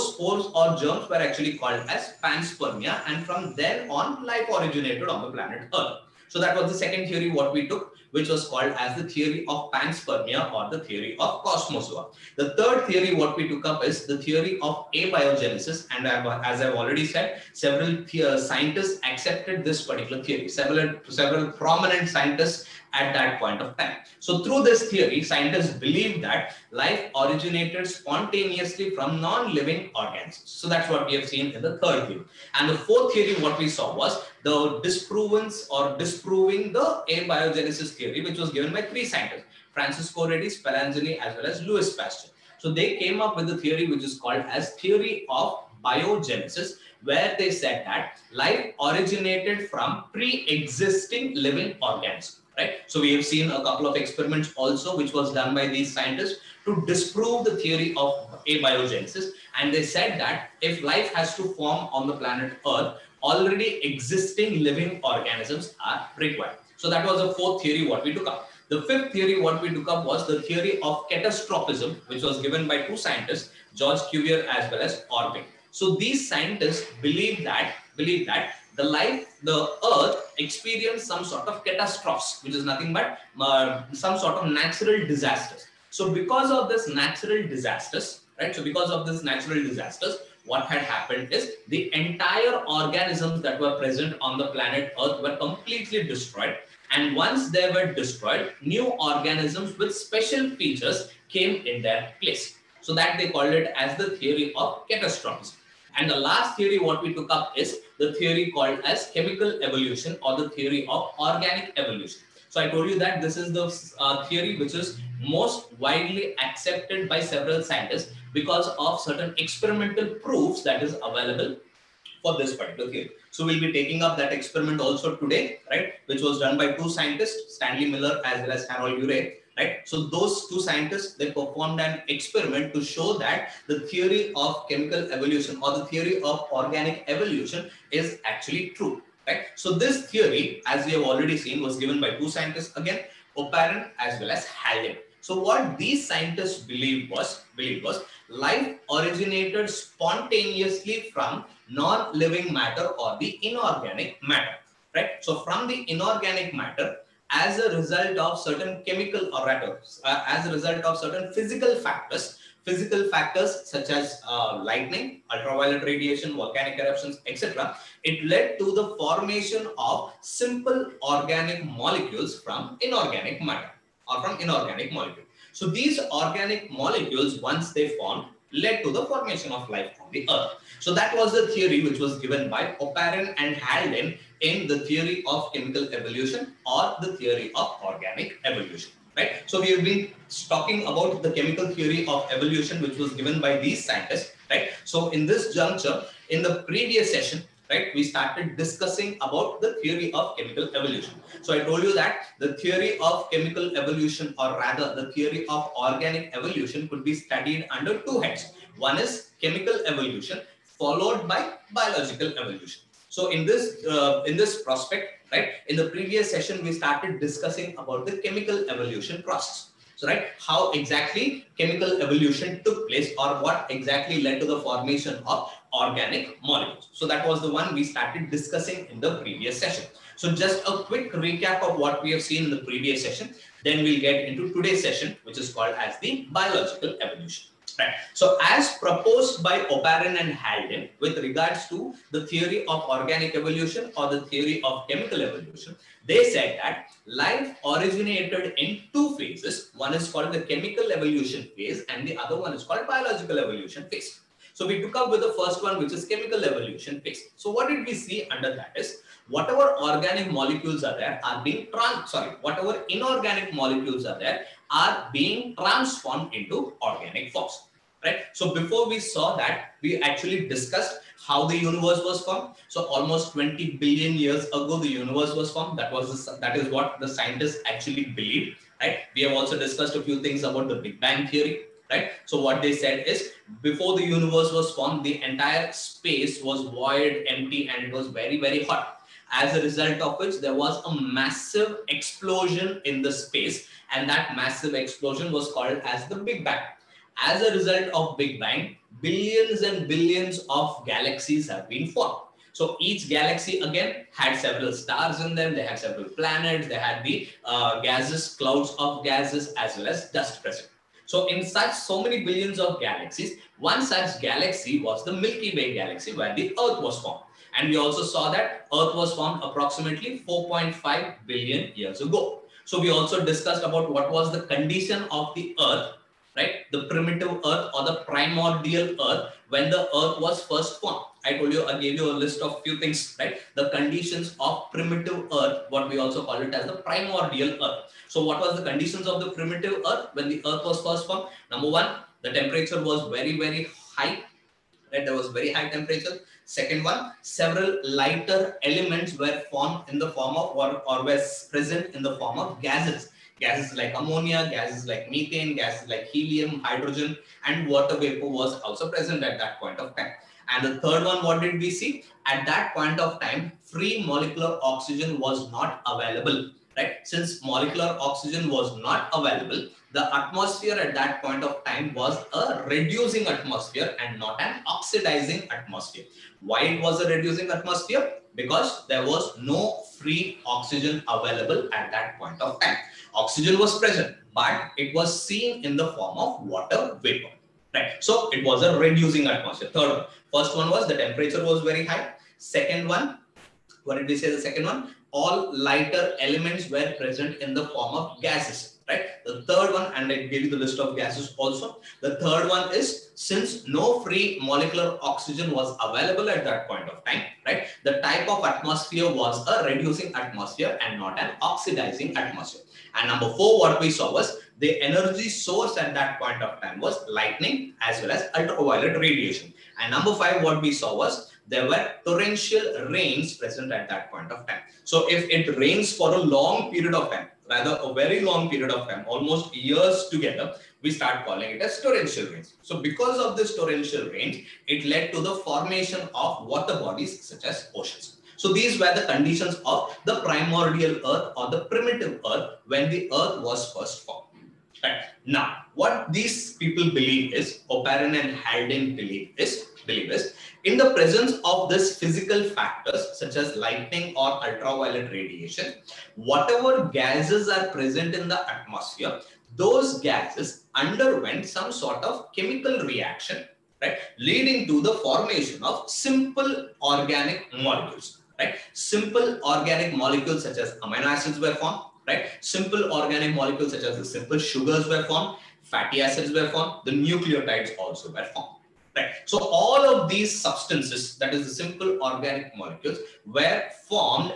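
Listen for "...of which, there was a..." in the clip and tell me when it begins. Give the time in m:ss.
4:50.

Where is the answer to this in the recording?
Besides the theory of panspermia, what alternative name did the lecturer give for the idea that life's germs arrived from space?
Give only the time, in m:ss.
0:10.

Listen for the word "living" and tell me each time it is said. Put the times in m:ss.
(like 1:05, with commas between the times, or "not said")
0:29, 0:51, 1:04, 2:31.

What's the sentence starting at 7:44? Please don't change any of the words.
Leading to the formation of simple organic molecules, right?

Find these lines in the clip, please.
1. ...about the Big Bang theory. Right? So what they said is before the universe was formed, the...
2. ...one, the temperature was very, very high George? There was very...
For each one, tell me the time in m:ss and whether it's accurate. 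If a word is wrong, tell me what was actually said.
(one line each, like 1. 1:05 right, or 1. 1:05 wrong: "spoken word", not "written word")
1. 4:40 right
2. 5:41 wrong: "Right", not "George".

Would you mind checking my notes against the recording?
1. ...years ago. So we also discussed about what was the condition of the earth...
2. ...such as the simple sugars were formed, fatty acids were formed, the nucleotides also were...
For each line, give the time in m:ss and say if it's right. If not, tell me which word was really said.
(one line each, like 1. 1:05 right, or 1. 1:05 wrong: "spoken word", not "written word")
1. 5:21 right
2. 7:53 right.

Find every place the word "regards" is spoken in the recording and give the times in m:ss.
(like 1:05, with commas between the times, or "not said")
4:01.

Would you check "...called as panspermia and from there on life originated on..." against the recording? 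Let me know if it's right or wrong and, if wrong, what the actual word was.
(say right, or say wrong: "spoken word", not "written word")
right.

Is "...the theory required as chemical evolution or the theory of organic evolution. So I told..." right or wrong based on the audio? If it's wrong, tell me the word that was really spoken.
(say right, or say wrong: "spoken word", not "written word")
wrong: "called", not "required".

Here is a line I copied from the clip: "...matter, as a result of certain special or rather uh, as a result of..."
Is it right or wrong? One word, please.
wrong.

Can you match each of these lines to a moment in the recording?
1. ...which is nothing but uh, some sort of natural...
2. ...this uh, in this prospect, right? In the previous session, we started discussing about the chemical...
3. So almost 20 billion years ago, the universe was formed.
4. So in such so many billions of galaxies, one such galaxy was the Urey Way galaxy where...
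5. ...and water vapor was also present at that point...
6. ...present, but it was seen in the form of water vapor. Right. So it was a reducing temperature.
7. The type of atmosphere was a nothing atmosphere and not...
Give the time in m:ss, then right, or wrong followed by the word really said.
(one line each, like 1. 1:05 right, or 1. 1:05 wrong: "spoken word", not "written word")
1. 1:22 right
2. 3:33 right
3. 4:32 right
4. 5:11 wrong: "Milky", not "Urey"
5. 5:57 right
6. 6:23 wrong: "atmosphere", not "temperature"
7. 6:47 wrong: "reducing", not "nothing".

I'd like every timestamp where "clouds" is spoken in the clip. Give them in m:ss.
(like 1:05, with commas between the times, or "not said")
5:08.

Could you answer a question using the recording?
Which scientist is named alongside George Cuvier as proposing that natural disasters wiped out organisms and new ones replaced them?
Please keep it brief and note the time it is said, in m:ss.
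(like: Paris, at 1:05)
Orbigny, at 1:15.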